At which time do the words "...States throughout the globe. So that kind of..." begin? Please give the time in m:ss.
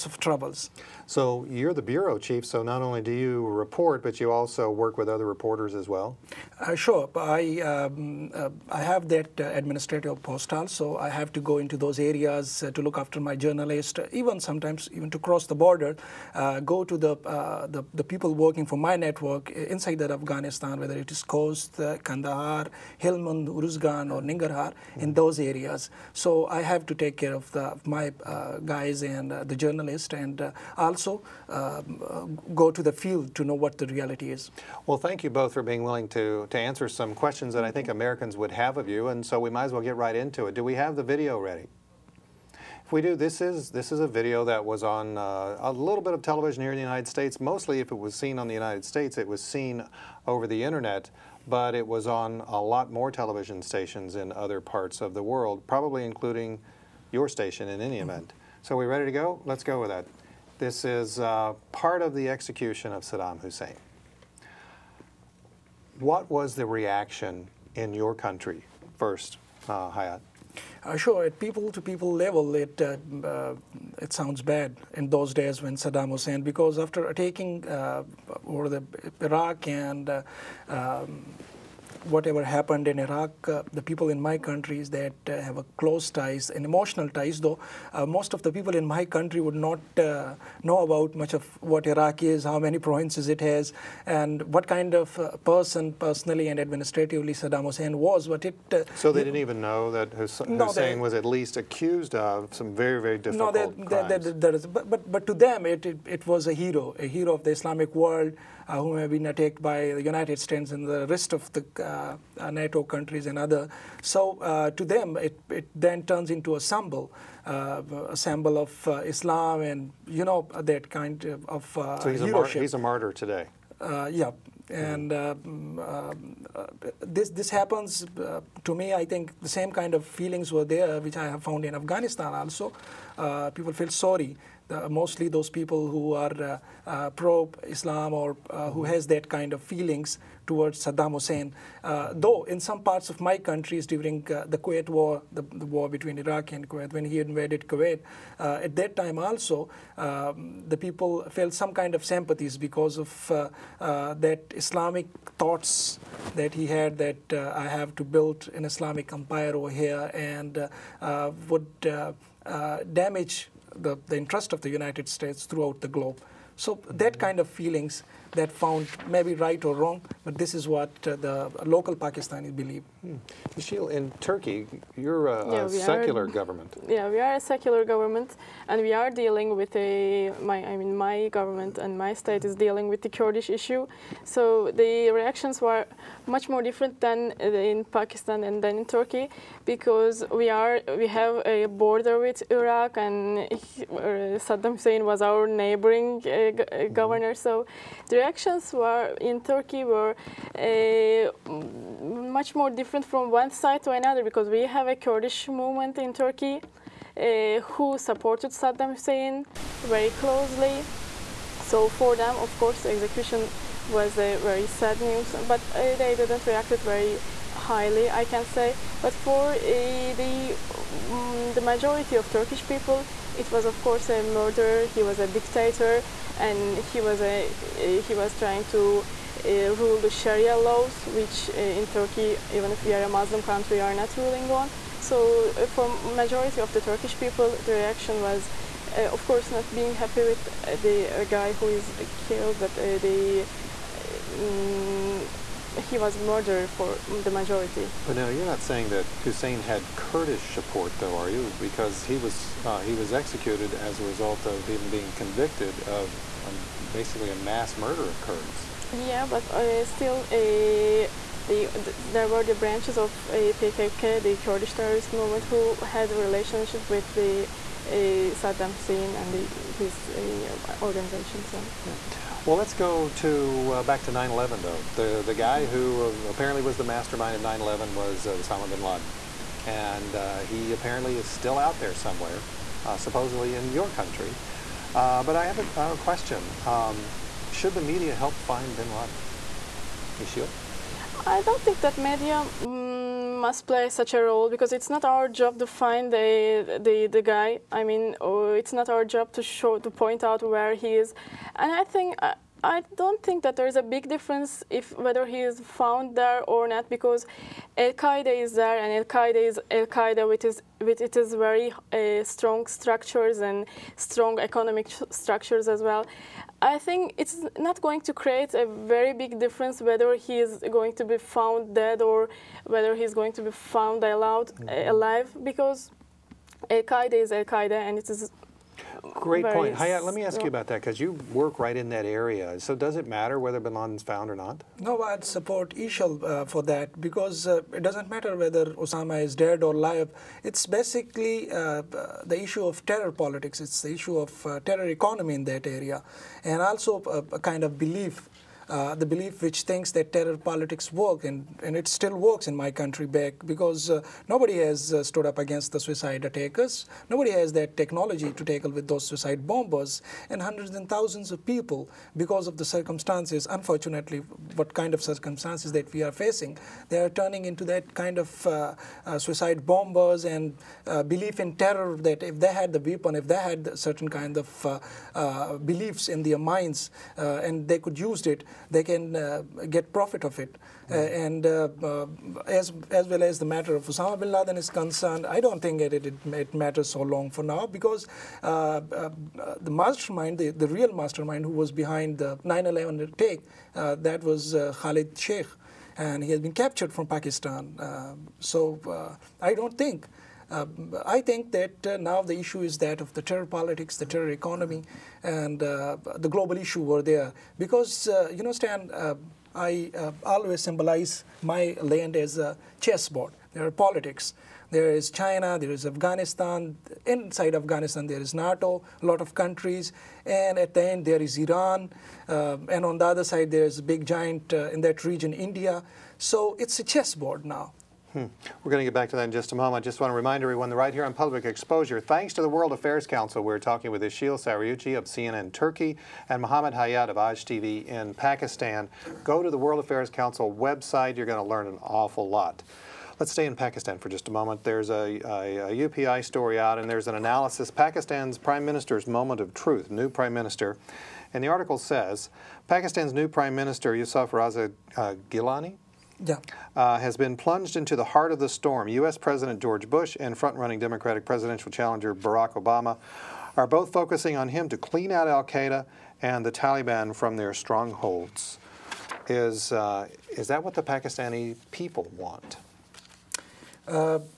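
2:45.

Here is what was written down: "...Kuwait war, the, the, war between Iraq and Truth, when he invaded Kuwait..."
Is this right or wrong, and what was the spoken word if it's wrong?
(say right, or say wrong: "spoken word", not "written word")
wrong: "Kuwait", not "Truth".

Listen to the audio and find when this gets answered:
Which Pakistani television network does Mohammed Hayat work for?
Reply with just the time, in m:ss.
7:17.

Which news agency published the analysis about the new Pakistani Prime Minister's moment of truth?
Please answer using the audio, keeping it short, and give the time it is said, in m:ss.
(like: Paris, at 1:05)
UPI, at 7:25.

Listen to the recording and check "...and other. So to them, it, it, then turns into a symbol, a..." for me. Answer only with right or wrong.
right.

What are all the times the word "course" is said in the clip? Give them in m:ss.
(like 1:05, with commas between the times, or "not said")
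3:32, 3:43, 3:59.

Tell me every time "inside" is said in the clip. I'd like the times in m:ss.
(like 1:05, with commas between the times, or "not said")
0:19, 6:57.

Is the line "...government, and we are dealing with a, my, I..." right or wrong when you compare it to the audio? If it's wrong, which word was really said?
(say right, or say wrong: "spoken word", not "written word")
right.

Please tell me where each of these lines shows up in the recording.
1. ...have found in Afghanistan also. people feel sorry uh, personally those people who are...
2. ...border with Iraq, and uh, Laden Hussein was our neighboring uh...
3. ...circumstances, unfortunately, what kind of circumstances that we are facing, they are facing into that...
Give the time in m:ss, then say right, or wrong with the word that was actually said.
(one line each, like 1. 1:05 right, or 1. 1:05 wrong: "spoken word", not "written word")
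1. 2:11 wrong: "mostly", not "personally"
2. 3:11 wrong: "Saddam", not "Laden"
3. 6:02 wrong: "turning", not "facing".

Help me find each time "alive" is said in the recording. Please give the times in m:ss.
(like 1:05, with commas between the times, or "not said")
5:24, 5:39.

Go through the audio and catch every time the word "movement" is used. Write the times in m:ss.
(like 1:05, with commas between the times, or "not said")
3:25, 4:25.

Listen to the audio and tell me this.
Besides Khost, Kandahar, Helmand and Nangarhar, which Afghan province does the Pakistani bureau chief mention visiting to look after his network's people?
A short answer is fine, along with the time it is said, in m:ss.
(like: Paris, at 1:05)
Uruzgan, at 0:23.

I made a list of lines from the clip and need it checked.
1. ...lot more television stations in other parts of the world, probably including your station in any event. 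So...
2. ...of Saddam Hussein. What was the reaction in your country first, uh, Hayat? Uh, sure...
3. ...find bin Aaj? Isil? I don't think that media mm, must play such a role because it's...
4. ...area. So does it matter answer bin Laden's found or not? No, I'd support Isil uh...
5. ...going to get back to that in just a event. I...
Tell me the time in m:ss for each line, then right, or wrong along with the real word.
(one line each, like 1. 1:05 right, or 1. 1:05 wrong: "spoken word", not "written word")
1. 0:52 right
2. 1:02 right
3. 4:48 wrong: "Laden", not "Aaj"
4. 5:32 wrong: "whether", not "answer"
5. 7:08 wrong: "moment", not "event".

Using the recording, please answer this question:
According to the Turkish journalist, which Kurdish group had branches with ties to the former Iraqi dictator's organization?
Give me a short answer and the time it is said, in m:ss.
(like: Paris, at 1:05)
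PKK, at 4:23.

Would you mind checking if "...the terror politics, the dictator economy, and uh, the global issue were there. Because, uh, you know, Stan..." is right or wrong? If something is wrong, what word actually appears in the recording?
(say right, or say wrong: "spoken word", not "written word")
wrong: "terror", not "dictator".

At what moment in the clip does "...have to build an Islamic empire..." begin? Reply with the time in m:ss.
2:37.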